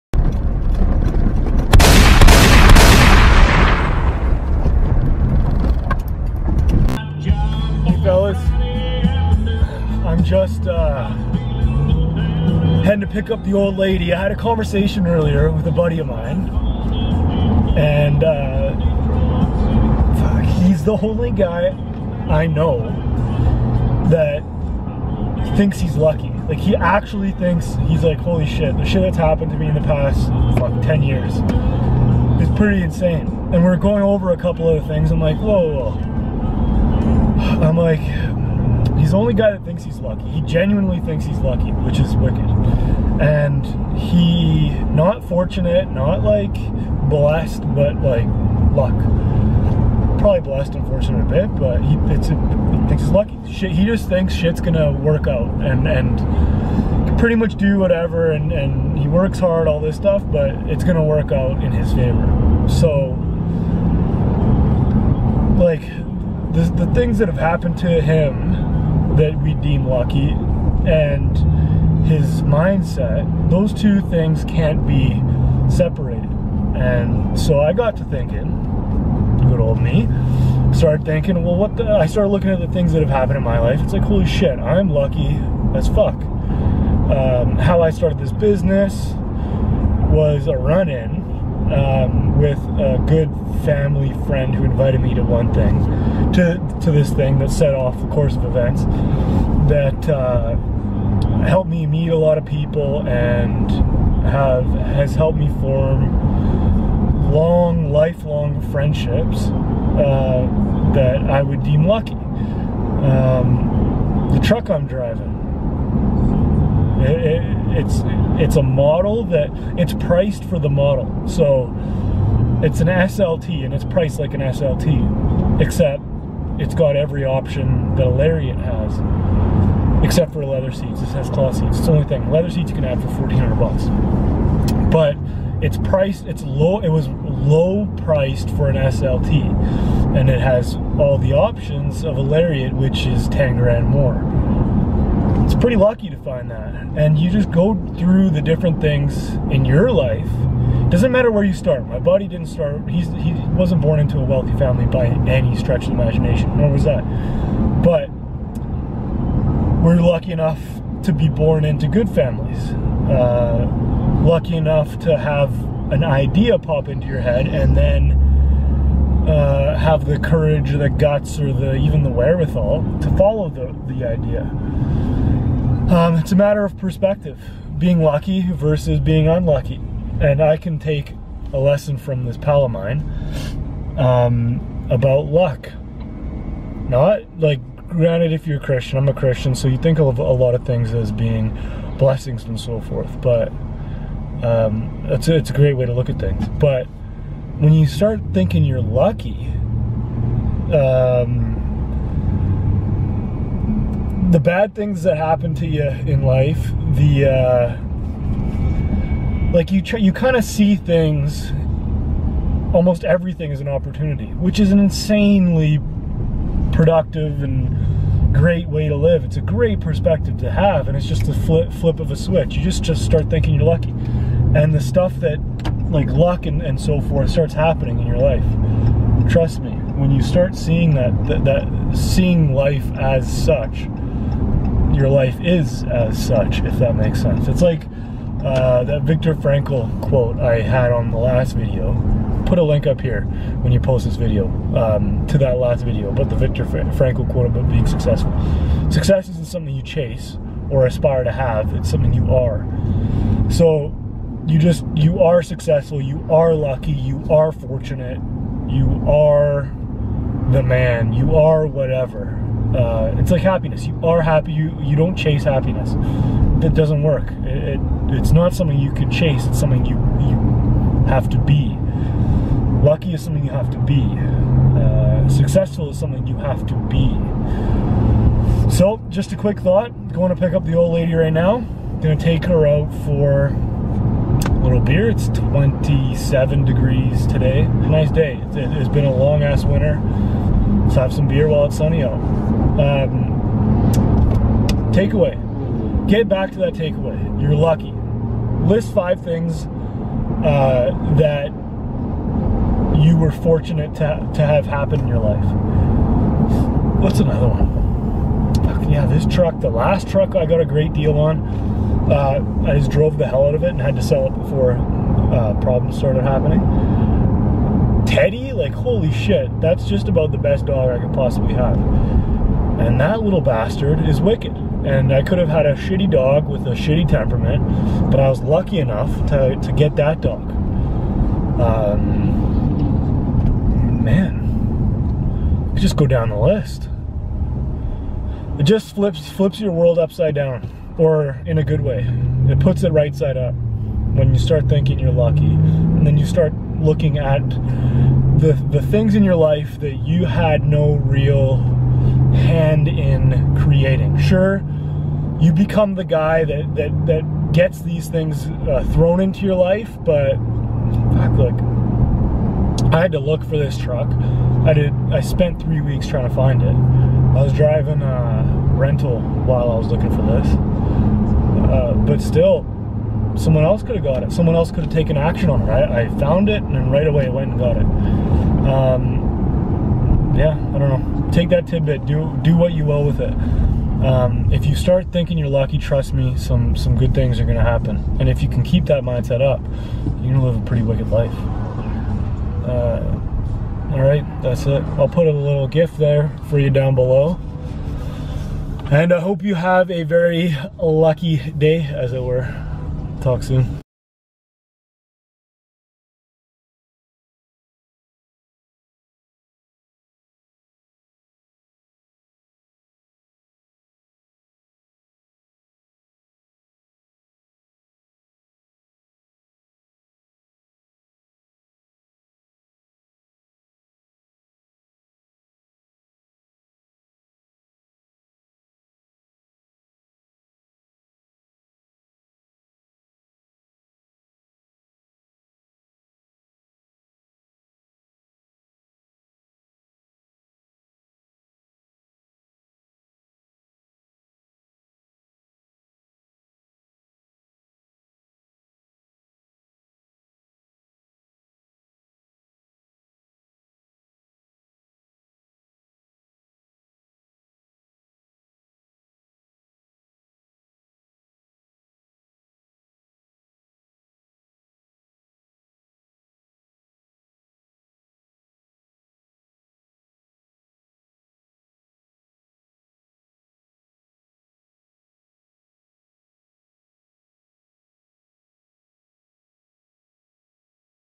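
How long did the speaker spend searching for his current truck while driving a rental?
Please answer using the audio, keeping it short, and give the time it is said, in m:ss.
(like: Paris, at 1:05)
3 weeks, at 6:05.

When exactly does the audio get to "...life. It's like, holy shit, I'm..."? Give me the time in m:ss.
1:23.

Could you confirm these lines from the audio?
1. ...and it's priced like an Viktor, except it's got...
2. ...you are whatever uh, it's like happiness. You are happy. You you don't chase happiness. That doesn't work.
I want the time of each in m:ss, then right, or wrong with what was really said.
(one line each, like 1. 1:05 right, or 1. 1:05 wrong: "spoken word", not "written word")
1. 2:03 wrong: "SLT", not "Viktor"
2. 4:21 right.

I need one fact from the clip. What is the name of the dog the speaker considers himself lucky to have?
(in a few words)
Teddy.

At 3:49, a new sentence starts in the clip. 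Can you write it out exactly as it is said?
Trust me, when you start seeing that, that, that seeing life as such, your life is as such, if that makes sense.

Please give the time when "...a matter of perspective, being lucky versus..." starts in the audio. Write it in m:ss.
2:56.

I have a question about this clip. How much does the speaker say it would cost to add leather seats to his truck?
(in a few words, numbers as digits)
$1,400.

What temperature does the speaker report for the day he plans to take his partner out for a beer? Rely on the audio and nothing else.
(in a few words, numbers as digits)
27 degrees.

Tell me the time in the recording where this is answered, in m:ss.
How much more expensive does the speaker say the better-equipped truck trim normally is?
2:23.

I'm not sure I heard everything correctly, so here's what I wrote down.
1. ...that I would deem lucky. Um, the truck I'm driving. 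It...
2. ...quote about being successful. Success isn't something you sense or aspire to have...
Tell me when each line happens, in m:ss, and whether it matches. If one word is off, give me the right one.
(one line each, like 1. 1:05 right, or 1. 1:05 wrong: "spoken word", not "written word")
1. 1:50 right
2. 4:07 wrong: "chase", not "sense".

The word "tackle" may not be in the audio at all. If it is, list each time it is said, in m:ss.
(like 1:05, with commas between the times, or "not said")
not said.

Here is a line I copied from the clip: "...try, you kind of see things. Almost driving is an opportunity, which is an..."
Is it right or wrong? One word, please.
wrong.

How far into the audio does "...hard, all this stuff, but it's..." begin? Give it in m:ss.
0:59.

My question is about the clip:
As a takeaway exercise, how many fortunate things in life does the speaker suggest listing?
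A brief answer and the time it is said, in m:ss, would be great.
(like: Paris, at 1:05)
5, at 4:58.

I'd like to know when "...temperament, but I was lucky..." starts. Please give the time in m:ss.
5:27.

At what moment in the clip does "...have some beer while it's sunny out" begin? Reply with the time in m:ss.
4:50.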